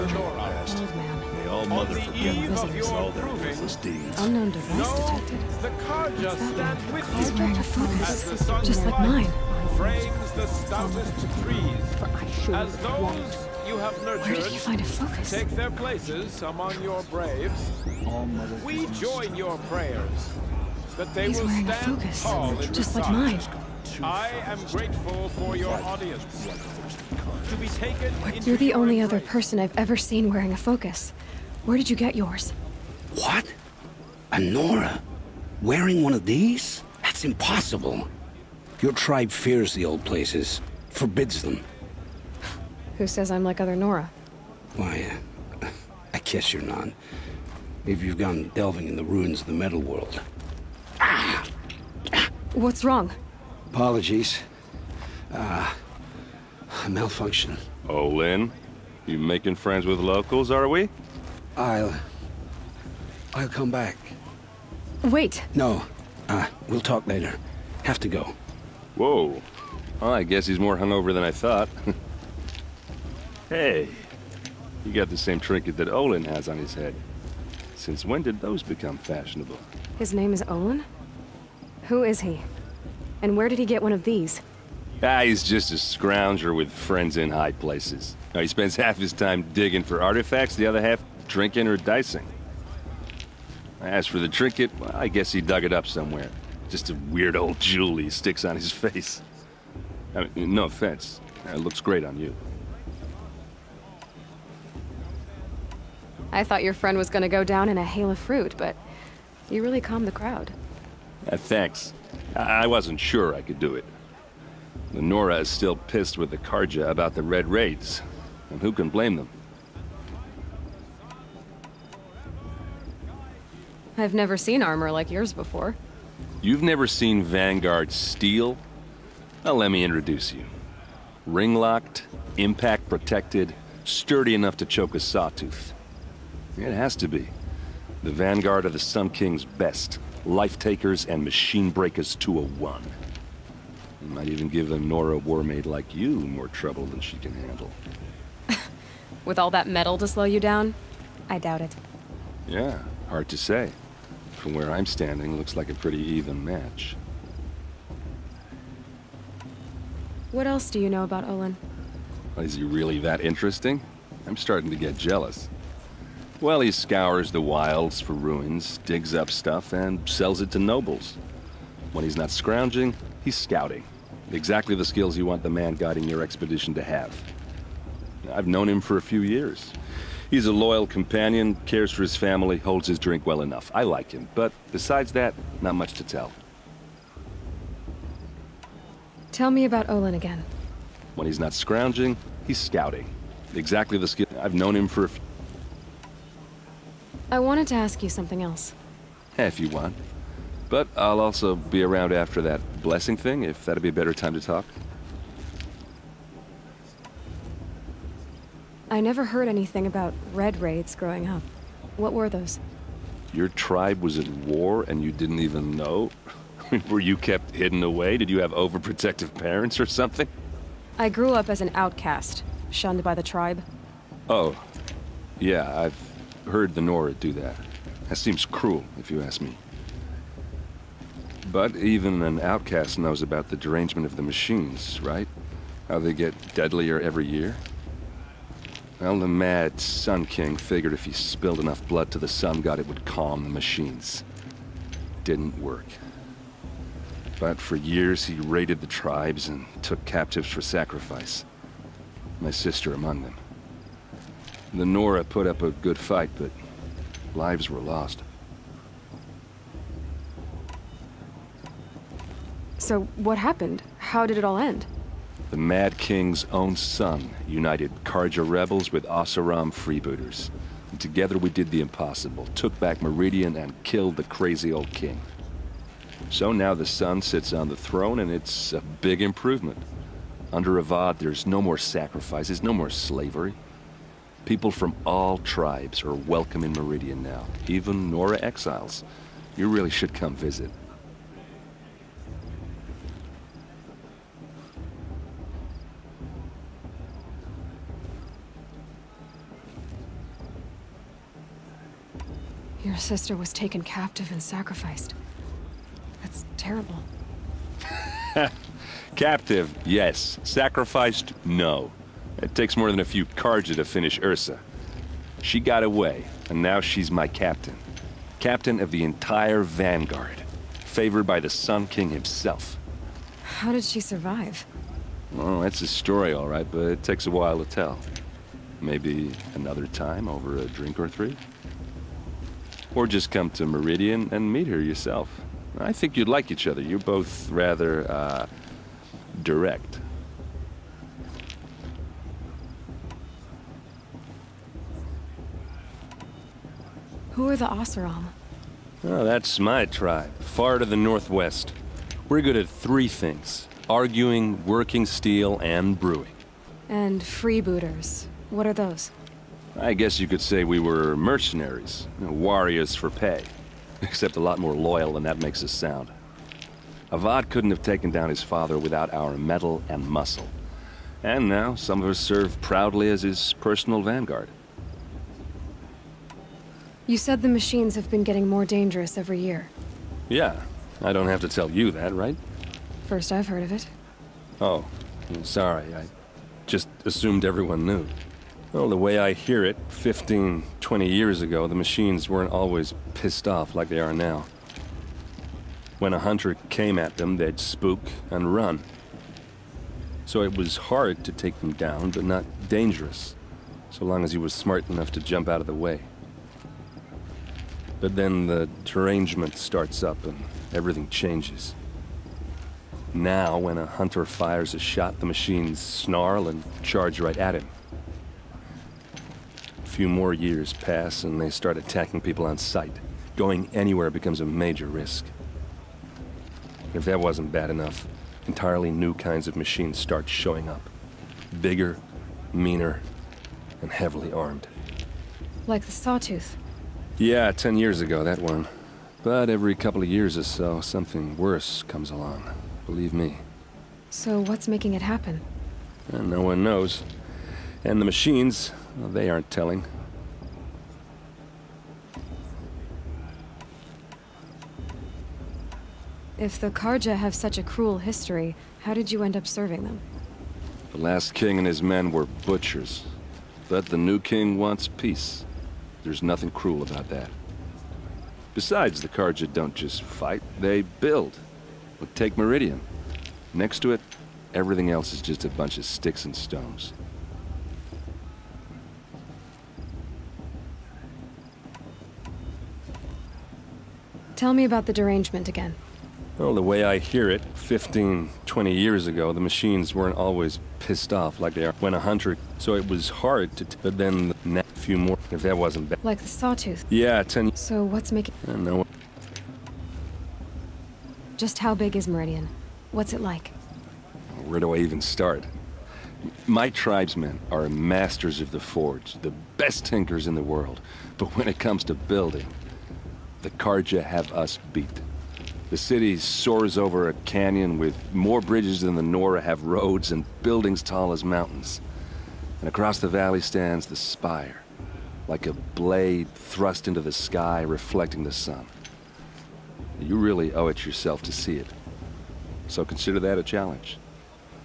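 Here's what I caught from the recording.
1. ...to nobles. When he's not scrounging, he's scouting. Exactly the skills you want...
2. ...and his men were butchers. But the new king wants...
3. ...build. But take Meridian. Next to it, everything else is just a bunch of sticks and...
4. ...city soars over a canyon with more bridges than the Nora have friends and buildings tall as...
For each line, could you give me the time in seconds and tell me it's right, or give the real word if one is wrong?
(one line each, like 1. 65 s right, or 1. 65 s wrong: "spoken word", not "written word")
1. 170 s right
2. 461 s right
3. 470 s right
4. 515 s wrong: "roads", not "friends".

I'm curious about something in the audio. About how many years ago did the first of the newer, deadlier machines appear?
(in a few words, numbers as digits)
10.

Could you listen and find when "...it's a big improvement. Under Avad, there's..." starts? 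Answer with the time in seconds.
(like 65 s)
278 s.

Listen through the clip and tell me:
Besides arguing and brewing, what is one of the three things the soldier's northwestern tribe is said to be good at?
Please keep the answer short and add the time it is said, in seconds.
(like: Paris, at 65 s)
Working steel, at 354 s.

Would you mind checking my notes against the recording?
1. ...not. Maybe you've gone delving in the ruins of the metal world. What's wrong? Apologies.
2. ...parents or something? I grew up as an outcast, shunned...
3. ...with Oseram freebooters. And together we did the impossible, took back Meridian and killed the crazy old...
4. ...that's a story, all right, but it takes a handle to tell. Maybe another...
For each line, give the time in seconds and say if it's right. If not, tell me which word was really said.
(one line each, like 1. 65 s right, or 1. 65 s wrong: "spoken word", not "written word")
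1. 46 s right
2. 219 s right
3. 268 s right
4. 325 s wrong: "while", not "handle".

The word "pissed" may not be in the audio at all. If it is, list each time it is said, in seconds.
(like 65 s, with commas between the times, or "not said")
115 s, 393 s, 490 s.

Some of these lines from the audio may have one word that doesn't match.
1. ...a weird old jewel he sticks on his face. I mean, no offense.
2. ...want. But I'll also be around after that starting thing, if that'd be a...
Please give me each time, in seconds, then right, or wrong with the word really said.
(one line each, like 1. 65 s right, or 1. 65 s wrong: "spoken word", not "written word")
1. 96 s right
2. 199 s wrong: "blessing", not "starting".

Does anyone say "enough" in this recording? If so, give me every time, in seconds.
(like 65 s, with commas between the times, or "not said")
134 s, 183 s, 241 s, 404 s, 427 s.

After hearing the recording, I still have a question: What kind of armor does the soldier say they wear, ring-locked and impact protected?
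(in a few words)
Vanguard steel.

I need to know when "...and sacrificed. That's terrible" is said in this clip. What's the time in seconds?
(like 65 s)
304 s.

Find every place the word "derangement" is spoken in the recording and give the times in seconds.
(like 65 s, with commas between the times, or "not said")
233 s, 408 s, 484 s.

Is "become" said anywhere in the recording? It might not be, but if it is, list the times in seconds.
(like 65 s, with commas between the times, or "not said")
78 s, 424 s.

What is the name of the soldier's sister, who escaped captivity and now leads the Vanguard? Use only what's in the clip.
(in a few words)
Ersa.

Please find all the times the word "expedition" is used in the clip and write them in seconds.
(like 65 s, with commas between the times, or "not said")
176 s.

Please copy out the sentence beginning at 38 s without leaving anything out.
Your tribe fears the old places, forbids them.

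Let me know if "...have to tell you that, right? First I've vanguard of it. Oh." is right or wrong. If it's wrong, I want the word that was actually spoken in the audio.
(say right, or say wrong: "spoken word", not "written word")
wrong: "heard", not "vanguard".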